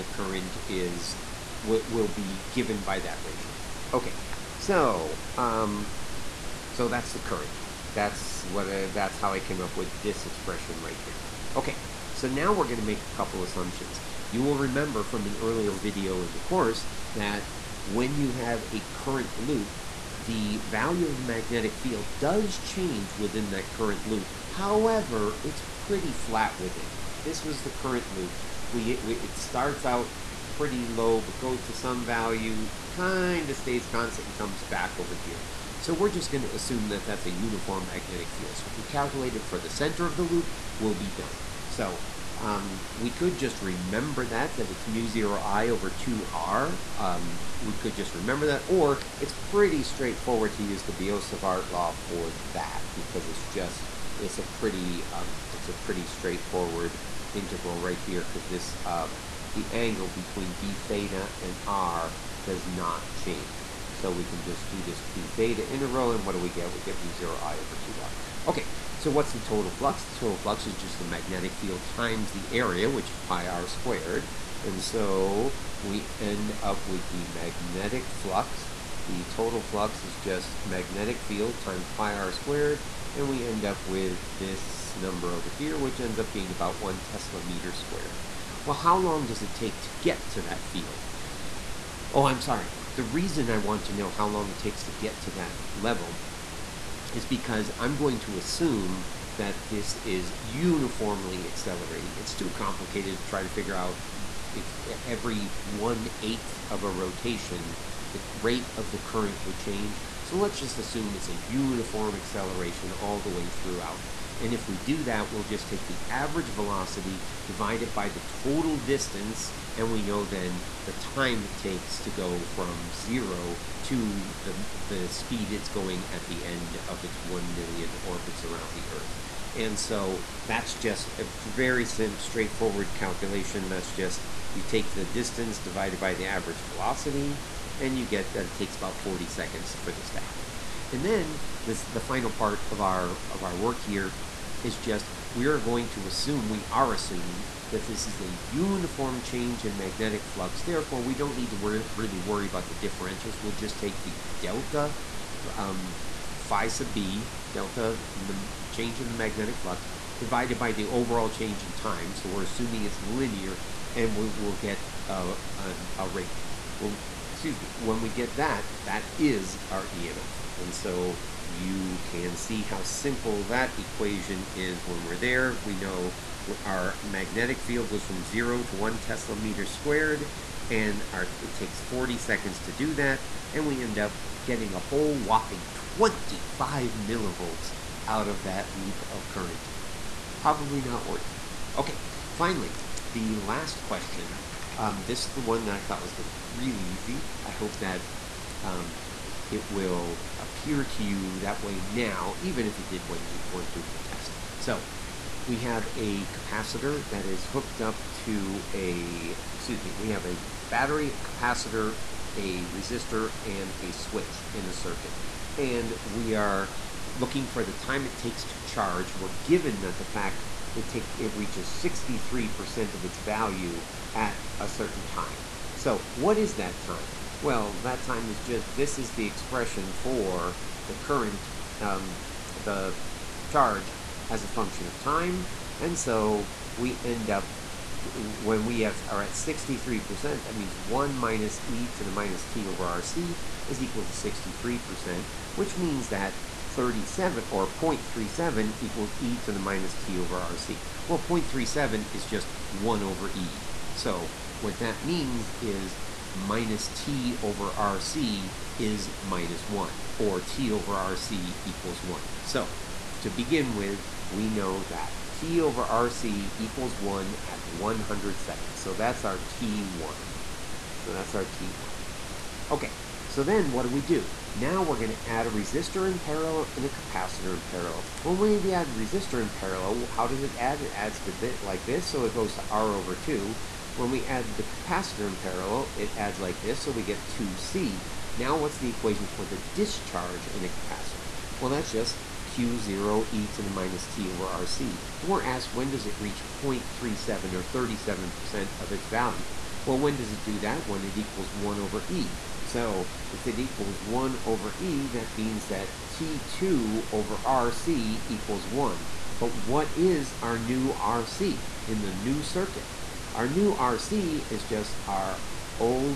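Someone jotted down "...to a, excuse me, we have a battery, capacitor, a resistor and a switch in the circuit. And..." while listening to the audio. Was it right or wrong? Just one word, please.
right.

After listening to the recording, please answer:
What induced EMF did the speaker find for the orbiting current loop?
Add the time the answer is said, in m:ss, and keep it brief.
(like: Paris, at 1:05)
25 millivolts, at 3:05.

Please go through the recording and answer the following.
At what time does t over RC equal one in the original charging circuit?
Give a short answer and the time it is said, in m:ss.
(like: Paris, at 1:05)
100 seconds, at 4:27.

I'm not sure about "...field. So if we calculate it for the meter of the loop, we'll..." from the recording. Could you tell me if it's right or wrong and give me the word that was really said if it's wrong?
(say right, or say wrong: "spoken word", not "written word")
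wrong: "center", not "meter".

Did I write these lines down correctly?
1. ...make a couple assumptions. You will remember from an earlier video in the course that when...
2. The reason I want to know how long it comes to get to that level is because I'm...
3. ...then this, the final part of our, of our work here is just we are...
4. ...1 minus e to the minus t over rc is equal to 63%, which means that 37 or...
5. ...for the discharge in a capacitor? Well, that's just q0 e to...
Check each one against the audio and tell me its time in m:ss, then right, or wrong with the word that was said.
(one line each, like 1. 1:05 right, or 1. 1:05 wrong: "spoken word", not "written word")
1. 0:12 right
2. 1:32 wrong: "takes", not "comes"
3. 2:21 right
4. 4:00 right
5. 4:49 right.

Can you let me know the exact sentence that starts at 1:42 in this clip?
It's too complicated to try to figure out it's every one eighth of a rotation, the rate of the current would change.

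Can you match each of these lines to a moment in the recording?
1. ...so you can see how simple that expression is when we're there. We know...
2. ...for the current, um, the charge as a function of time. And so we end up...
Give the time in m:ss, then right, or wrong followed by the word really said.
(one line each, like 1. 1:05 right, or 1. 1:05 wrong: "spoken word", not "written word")
1. 2:50 wrong: "equation", not "expression"
2. 3:49 right.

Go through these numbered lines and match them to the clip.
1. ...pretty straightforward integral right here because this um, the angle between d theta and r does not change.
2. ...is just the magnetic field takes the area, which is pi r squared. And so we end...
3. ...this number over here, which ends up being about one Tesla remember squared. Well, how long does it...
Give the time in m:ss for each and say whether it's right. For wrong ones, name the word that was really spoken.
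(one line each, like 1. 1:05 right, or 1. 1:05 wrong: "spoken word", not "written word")
1. 0:55 right
2. 1:10 wrong: "times", not "takes"
3. 1:24 wrong: "meter", not "remember".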